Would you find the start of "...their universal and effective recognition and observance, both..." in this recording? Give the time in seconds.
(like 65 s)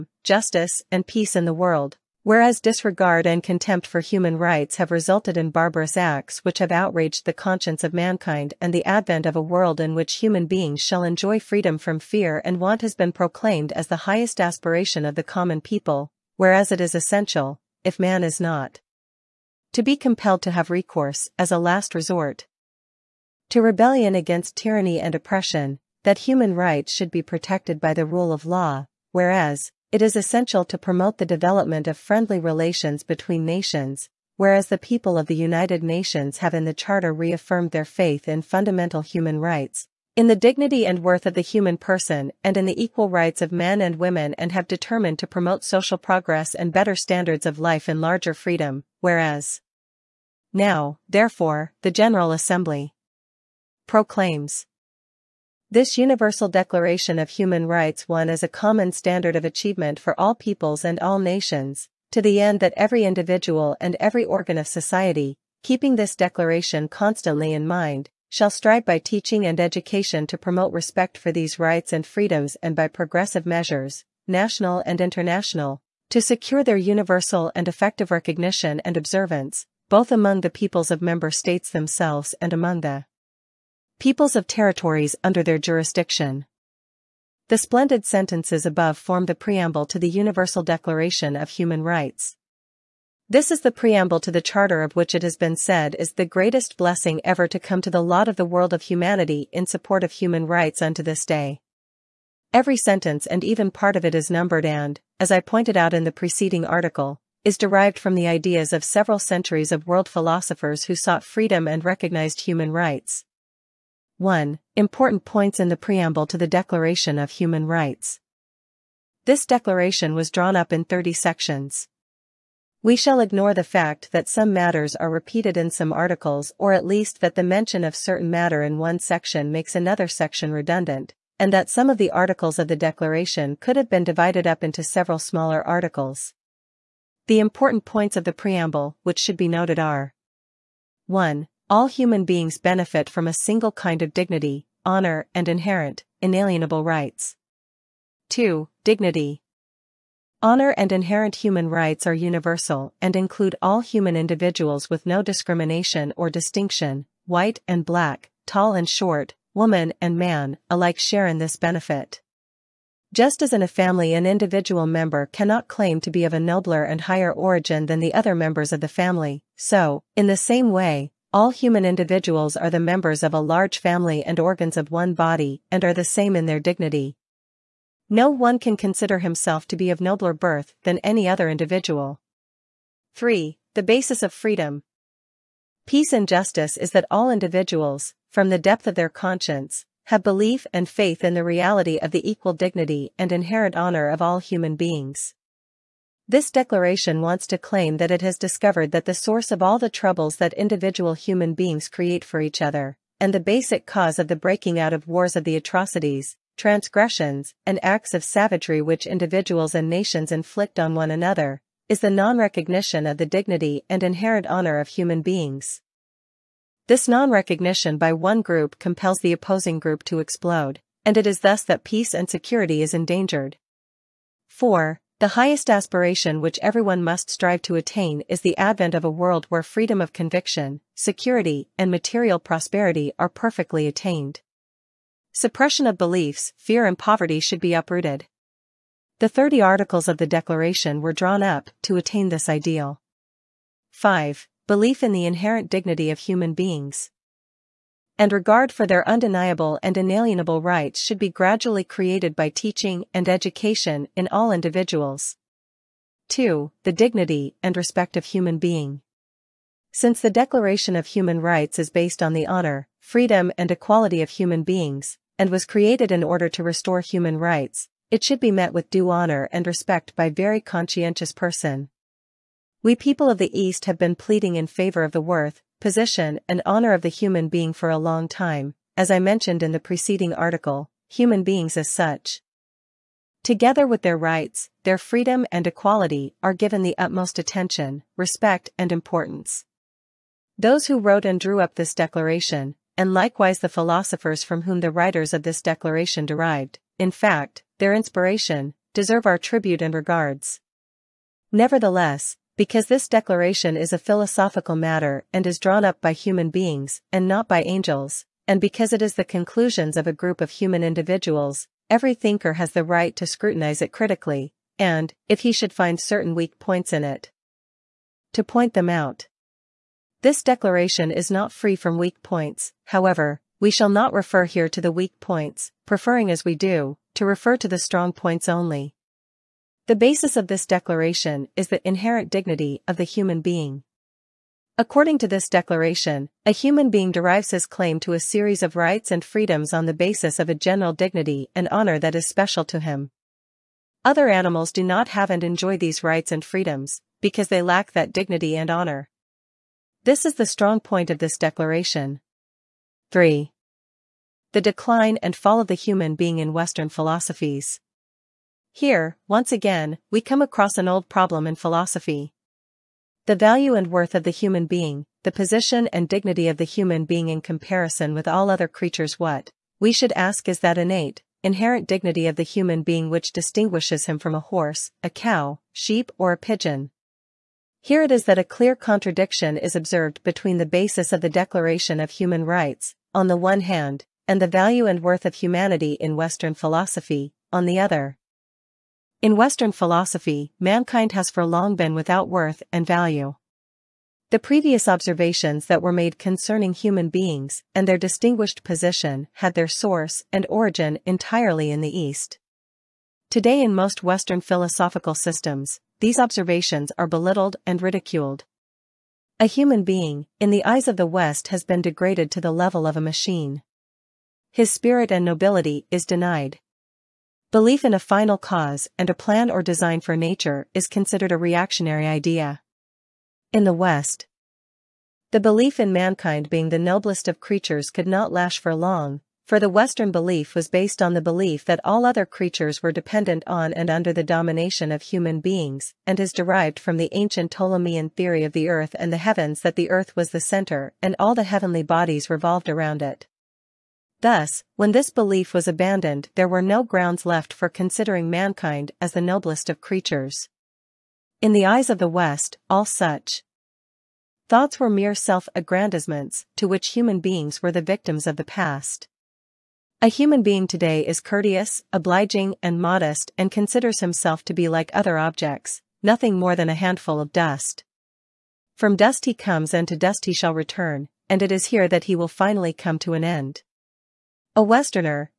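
76 s.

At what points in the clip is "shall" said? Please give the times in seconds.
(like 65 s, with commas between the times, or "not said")
10 s, 68 s, 122 s, 323 s, 470 s.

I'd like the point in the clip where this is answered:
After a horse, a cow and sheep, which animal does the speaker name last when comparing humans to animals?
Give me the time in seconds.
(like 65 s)
376 s.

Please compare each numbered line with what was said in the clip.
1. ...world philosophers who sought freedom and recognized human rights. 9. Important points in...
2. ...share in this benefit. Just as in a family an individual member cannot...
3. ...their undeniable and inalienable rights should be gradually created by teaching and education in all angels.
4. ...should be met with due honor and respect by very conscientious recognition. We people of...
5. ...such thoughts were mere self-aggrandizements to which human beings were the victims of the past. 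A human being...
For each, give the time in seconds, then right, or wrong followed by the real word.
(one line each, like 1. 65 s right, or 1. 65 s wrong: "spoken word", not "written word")
1. 109 s wrong: "1", not "9"
2. 160 s right
3. 248 s wrong: "individuals", not "angels"
4. 268 s wrong: "person", not "recognition"
5. 452 s right.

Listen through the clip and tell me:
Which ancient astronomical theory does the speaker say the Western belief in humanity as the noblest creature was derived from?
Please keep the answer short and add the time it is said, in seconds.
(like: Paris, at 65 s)
Ptolemean theory, at 437 s.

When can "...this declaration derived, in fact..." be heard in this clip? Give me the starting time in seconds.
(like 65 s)
295 s.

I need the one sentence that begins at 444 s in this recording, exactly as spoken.
Thus, when this belief was abandoned there were no grounds left for considering mankind as the noblest of creatures.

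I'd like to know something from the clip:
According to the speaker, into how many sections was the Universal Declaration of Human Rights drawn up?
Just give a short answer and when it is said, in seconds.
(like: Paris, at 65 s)
30, at 120 s.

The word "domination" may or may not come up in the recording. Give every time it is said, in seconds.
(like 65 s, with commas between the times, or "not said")
434 s.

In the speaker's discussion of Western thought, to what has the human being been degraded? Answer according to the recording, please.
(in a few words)
a machine.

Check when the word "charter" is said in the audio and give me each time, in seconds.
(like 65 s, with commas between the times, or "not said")
36 s, 94 s.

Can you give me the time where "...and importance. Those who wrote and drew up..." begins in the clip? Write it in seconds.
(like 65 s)
288 s.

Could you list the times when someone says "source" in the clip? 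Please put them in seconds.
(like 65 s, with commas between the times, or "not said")
199 s, 399 s.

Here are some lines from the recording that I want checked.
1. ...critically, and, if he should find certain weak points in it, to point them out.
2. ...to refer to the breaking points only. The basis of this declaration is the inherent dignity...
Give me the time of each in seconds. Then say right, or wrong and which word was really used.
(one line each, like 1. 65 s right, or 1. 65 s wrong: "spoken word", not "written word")
1. 313 s right
2. 327 s wrong: "strong", not "breaking".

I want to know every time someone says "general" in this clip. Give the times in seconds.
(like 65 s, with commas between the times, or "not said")
51 s, 340 s.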